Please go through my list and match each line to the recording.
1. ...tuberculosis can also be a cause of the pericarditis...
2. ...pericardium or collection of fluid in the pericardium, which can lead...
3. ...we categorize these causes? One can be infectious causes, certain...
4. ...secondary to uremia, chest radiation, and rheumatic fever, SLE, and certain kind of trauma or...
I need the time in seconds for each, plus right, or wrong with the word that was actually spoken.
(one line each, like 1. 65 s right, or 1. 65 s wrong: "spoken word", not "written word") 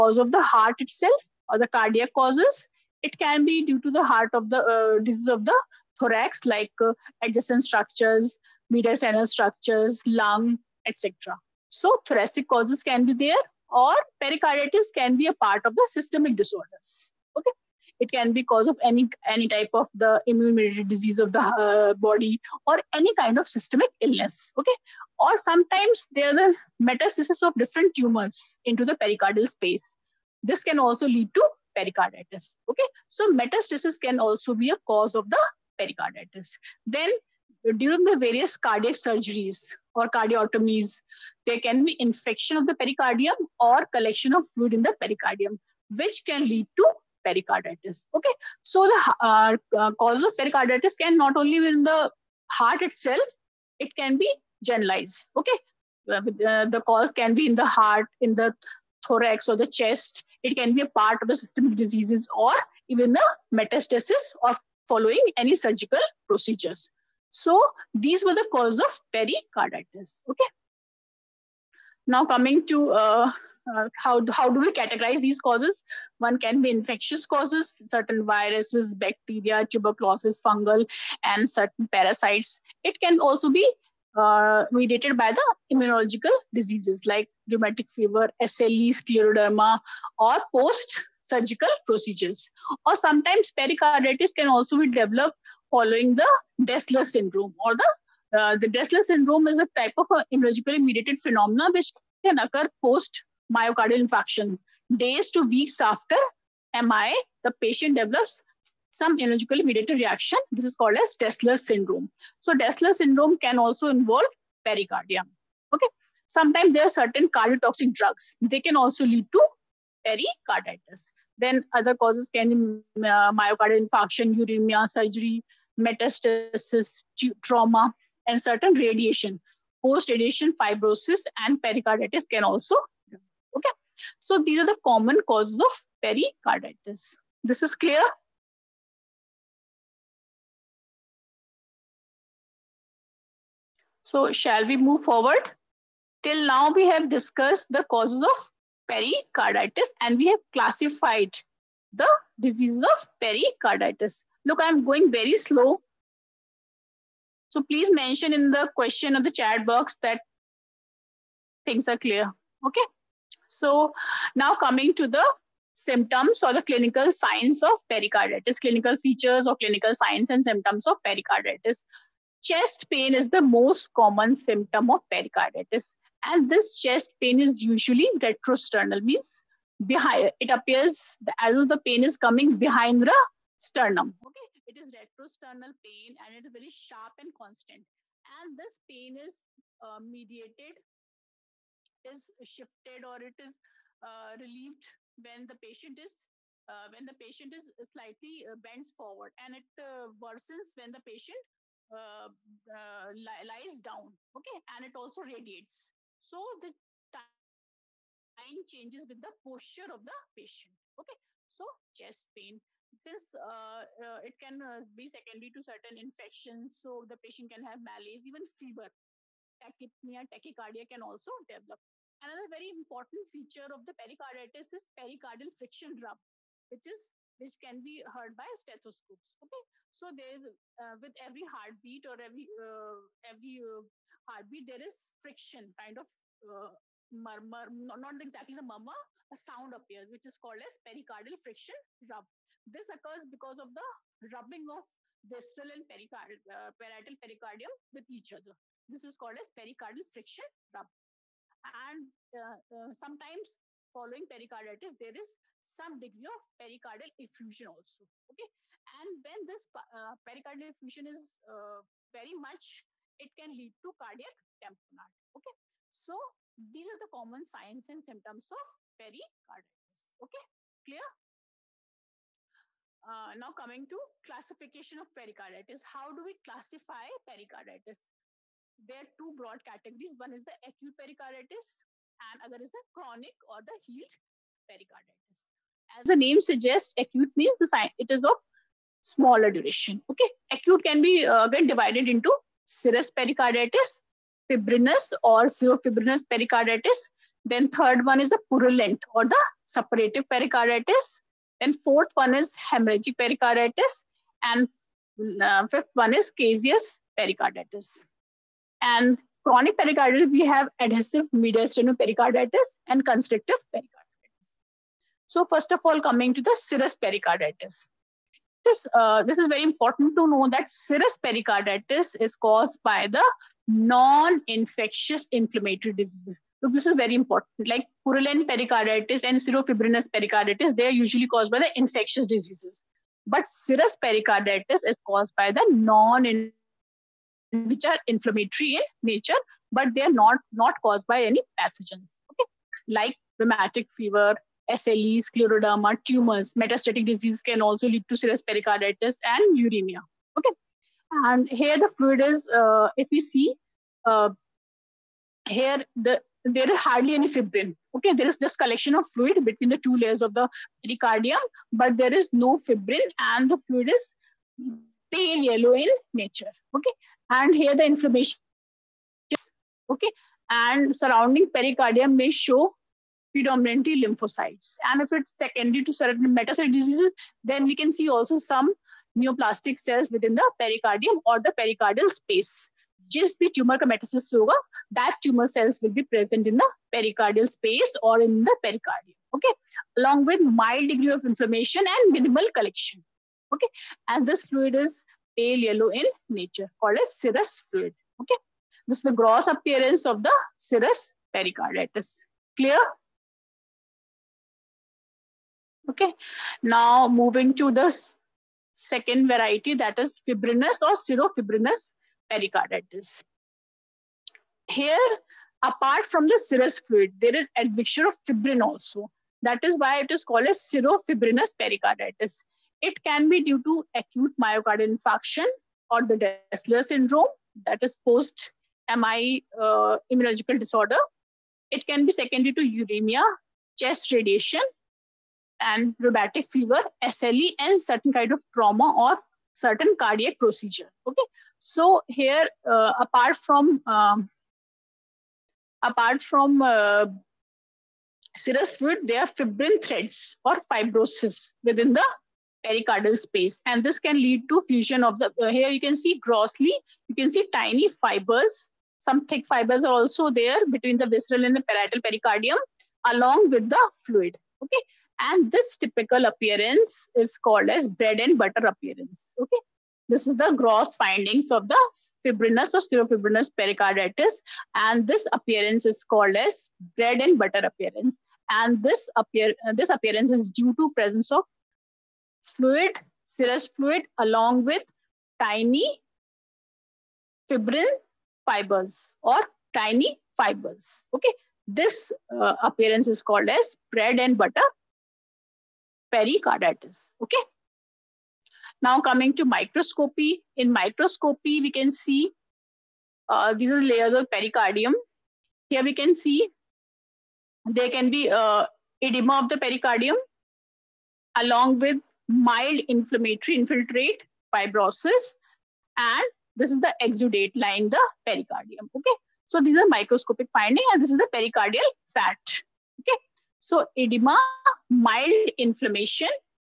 1. 33 s wrong: "metastasis", not "tuberculosis"
2. 42 s right
3. 74 s right
4. 432 s right.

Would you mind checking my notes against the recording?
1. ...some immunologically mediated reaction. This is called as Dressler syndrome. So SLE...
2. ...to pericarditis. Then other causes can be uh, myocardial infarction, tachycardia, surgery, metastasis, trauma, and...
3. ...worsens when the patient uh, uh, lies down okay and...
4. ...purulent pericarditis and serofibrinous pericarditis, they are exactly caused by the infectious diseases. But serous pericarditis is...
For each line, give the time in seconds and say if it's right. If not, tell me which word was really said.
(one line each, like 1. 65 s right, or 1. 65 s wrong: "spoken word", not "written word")
1. 108 s wrong: "Dressler", not "SLE"
2. 119 s wrong: "uremia", not "tachycardia"
3. 200 s right
4. 328 s wrong: "usually", not "exactly".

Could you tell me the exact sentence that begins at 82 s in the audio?
It can also be uh, mediated by the immunological diseases like rheumatic fever, SLE, scleroderma, or post surgical procedures.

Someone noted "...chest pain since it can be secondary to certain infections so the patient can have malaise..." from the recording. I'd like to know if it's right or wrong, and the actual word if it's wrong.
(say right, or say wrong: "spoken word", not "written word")
right.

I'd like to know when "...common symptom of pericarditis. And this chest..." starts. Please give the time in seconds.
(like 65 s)
173 s.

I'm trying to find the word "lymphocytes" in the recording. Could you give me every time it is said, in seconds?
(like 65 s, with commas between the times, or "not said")
374 s.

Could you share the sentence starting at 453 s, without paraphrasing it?
And this can lead to fusion of the, uh, here you can see grossly, you can see tiny fibers.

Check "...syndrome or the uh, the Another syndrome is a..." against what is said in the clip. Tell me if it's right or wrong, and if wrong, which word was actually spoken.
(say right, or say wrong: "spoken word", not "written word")
wrong: "Dressler", not "Another".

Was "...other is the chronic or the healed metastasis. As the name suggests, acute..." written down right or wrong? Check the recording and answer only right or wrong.
wrong.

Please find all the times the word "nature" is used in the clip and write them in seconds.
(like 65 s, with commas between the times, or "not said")
339 s, 366 s, 396 s.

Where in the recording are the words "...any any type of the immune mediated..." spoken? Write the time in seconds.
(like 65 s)
18 s.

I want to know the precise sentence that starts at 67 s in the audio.
So these were the cause of pericarditis.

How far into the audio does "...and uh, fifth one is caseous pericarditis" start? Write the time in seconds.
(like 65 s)
304 s.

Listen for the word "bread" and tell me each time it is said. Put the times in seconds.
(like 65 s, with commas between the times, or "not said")
467 s, 476 s, 493 s.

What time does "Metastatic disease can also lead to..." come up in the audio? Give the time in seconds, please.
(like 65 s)
346 s.